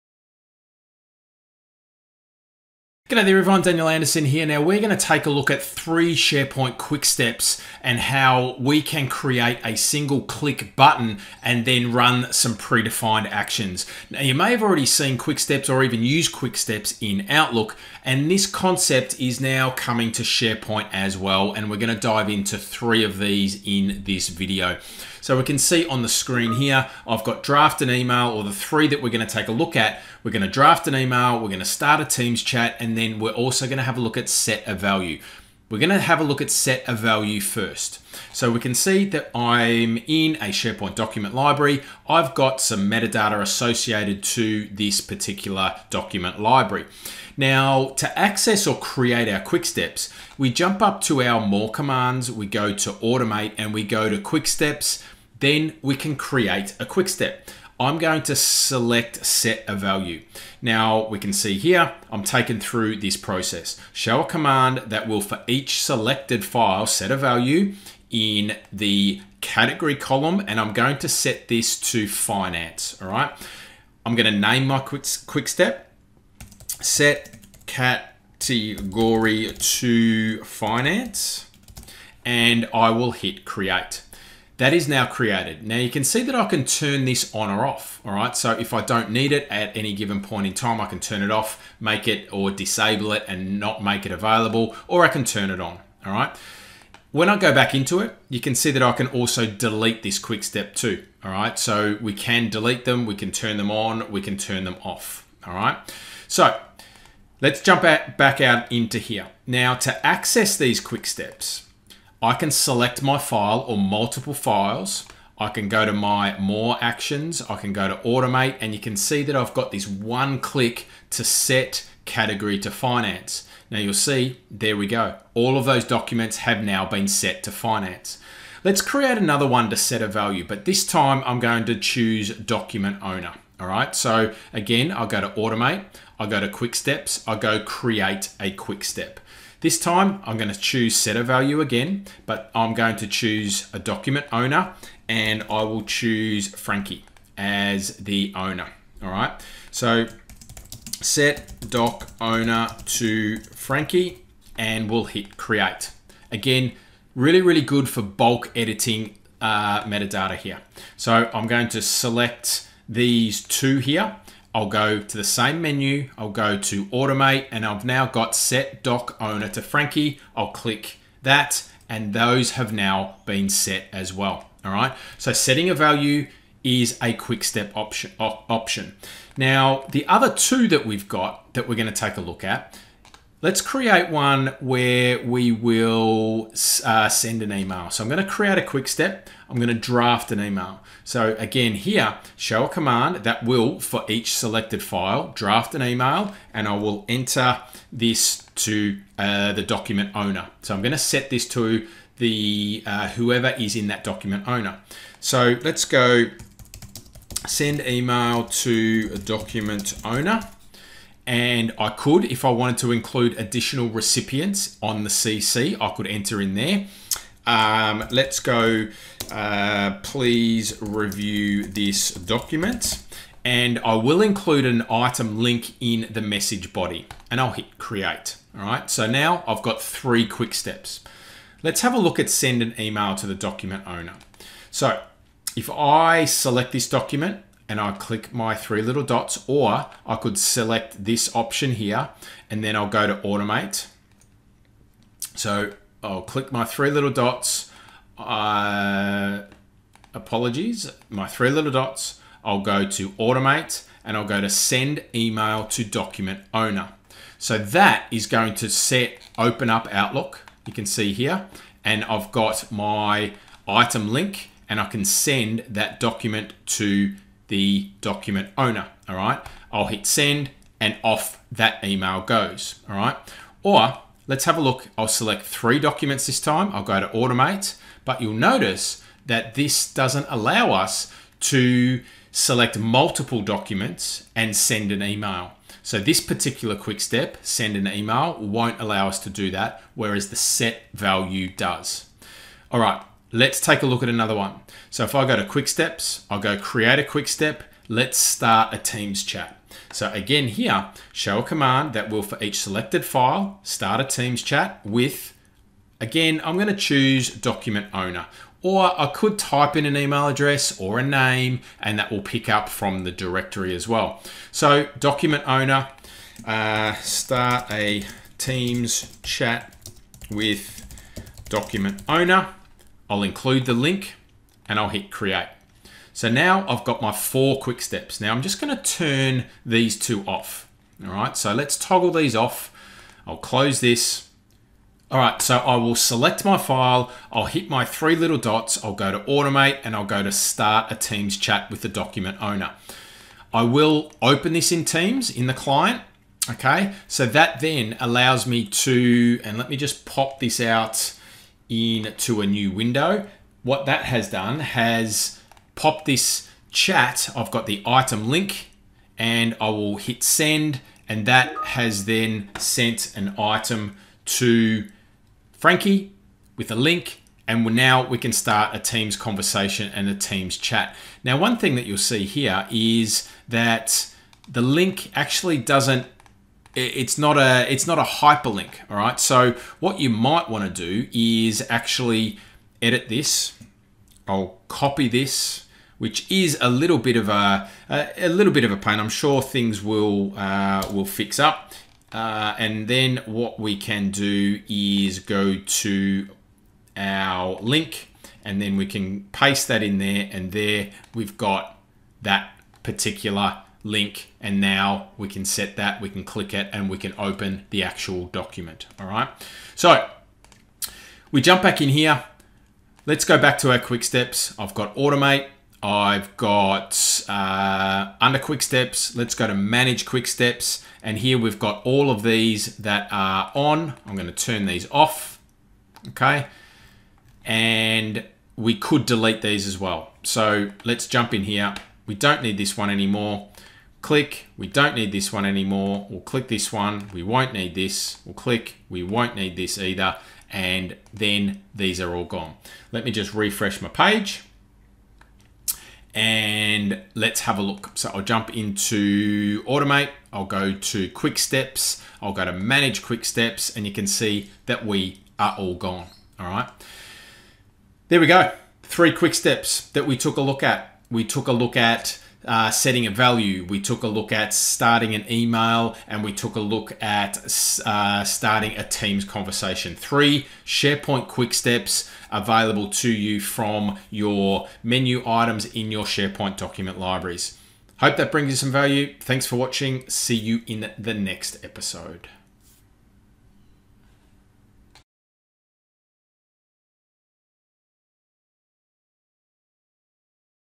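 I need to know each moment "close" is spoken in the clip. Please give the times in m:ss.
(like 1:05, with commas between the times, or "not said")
5:33.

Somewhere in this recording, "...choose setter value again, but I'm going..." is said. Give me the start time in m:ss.
2:20.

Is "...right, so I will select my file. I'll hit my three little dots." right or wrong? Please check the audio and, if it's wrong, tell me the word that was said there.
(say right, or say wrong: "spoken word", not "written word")
right.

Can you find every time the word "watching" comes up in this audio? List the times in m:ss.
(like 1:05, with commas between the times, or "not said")
7:59.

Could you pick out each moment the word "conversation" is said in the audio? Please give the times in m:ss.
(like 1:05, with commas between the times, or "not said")
6:09, 7:49.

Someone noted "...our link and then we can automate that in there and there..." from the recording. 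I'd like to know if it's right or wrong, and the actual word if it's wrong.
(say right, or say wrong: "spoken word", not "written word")
wrong: "paste", not "automate".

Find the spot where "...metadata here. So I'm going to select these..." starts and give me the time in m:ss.
2:39.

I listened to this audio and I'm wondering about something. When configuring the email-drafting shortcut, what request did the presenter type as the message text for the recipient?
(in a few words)
Please review this document.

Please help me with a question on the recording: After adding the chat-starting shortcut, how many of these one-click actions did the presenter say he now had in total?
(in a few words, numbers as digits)
4.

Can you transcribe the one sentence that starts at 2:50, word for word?
I'll click that, and those have now been set as well.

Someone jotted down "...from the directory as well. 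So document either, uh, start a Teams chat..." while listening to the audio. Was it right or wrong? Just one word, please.
wrong.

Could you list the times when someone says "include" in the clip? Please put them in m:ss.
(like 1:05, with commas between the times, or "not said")
3:32, 3:44, 5:23.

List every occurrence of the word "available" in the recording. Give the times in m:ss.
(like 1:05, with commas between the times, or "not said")
1:34, 7:52.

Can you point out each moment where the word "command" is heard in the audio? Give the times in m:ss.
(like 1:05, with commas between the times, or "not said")
0:51, 1:04, 3:12, 5:01.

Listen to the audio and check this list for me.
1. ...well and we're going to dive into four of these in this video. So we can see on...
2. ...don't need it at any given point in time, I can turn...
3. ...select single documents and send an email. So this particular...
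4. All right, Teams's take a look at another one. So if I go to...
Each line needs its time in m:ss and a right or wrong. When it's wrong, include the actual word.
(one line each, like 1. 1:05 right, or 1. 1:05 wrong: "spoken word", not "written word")
1. 0:21 wrong: "three", not "four"
2. 1:28 right
3. 4:42 wrong: "multiple", not "single"
4. 4:52 wrong: "Let", not "Teams".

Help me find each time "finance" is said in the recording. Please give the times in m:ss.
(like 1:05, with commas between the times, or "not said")
1:12, 1:20, 2:02, 2:07.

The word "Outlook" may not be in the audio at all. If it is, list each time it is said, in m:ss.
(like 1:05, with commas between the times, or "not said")
0:17, 4:19.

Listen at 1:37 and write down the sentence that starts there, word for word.
When I go back into it, you can see that I can also delete this quick step too, all right?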